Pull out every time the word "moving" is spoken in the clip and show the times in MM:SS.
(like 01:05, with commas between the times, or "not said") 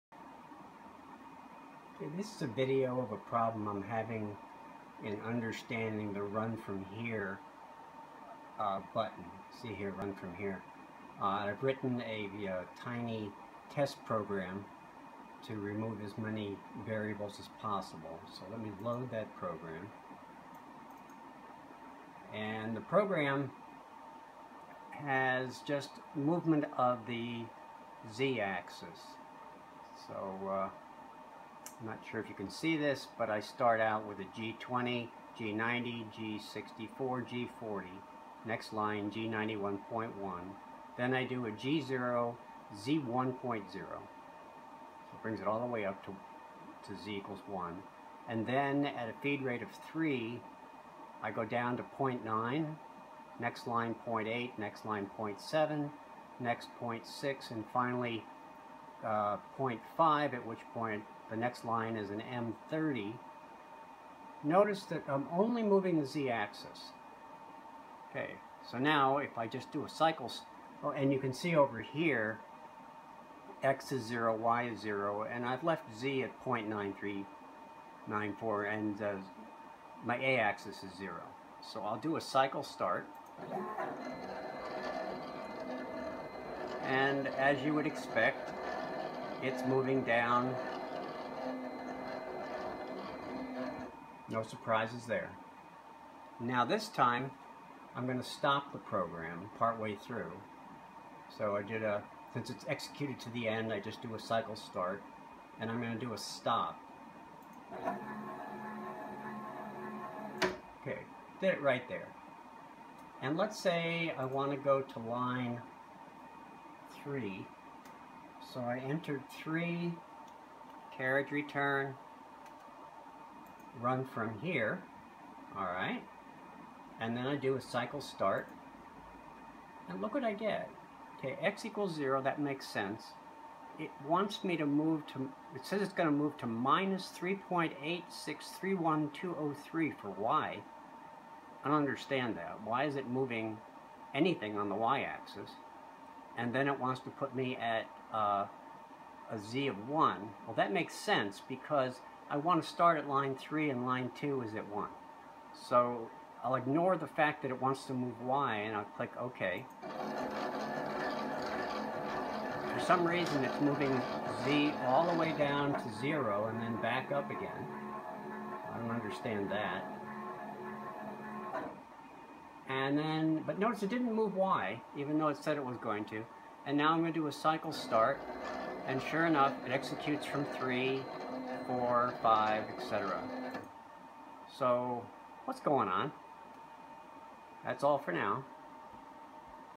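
01:05, 01:29, 02:23, 02:43.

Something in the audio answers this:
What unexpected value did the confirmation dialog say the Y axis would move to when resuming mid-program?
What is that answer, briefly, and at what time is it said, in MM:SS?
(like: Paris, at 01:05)
-3.8631203, at 02:16.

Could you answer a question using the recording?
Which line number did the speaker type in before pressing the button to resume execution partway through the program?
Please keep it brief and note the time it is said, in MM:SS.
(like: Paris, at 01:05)
3, at 01:59.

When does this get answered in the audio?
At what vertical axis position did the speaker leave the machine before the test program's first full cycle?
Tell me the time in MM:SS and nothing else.
01:16.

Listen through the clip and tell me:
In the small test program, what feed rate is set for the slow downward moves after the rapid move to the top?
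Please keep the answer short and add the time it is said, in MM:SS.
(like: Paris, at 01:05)
3, at 00:49.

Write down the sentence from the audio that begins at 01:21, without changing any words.
So I'll do a cycle start.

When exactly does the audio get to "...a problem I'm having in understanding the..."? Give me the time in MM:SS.
00:03.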